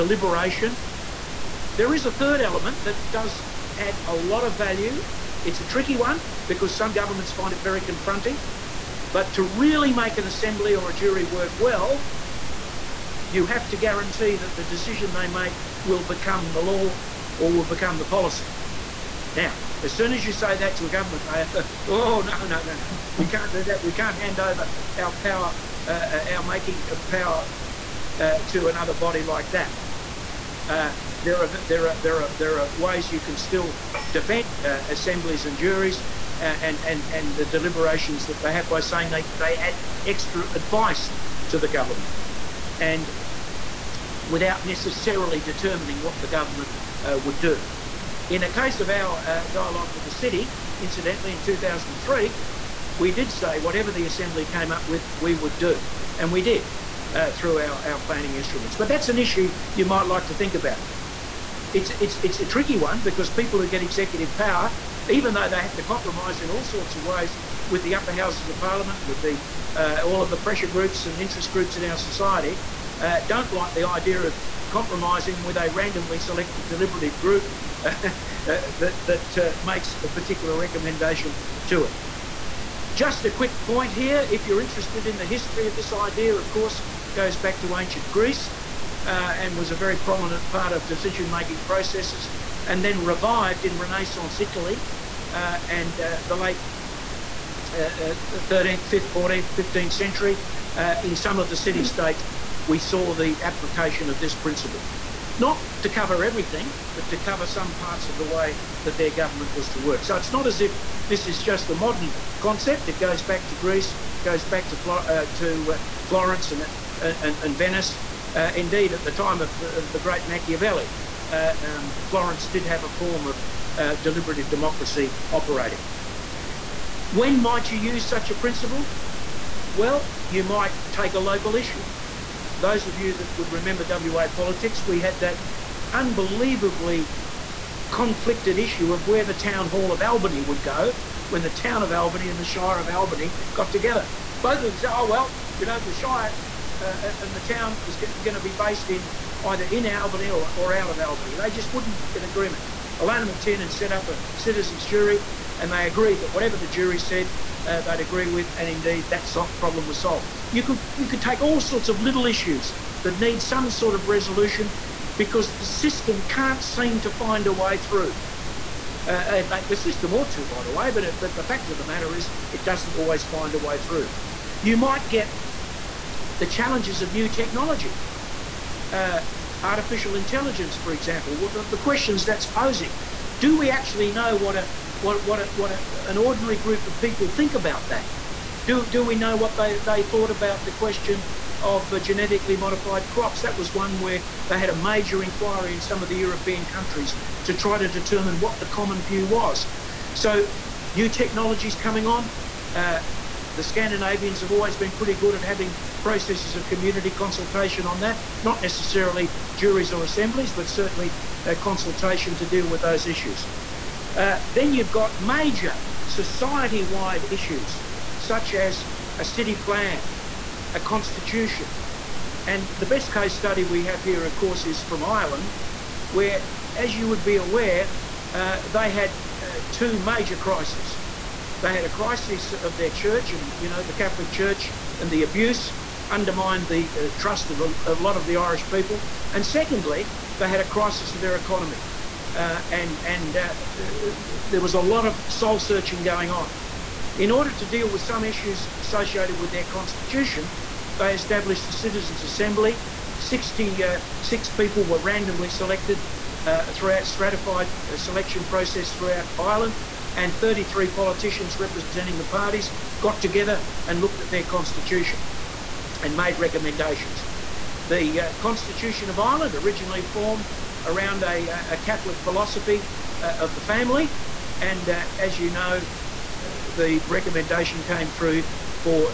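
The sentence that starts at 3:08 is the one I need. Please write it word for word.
Do do we know what they they thought about the question of uh, genetically modified crops?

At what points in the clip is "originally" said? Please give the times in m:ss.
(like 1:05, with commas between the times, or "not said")
4:29.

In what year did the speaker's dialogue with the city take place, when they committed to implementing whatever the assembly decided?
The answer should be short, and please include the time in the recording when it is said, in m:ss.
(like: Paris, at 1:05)
2003, at 0:51.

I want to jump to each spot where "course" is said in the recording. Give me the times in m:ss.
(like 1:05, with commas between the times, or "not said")
1:26, 3:44.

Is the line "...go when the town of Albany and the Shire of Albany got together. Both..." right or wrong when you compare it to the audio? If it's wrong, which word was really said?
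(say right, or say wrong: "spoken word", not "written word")
right.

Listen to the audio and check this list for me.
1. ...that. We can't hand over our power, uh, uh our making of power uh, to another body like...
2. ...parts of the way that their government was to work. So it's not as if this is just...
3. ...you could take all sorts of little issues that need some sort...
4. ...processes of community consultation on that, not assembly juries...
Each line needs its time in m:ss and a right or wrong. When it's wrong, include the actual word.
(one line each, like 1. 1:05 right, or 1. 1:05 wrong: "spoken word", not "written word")
1. 0:23 right
2. 1:47 right
3. 2:40 right
4. 3:25 wrong: "necessarily", not "assembly".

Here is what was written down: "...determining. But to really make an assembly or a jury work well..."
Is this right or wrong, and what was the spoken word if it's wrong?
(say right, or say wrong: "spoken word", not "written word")
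wrong: "confronting", not "determining".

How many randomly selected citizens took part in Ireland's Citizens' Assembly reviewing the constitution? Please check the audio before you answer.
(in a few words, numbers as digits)
66.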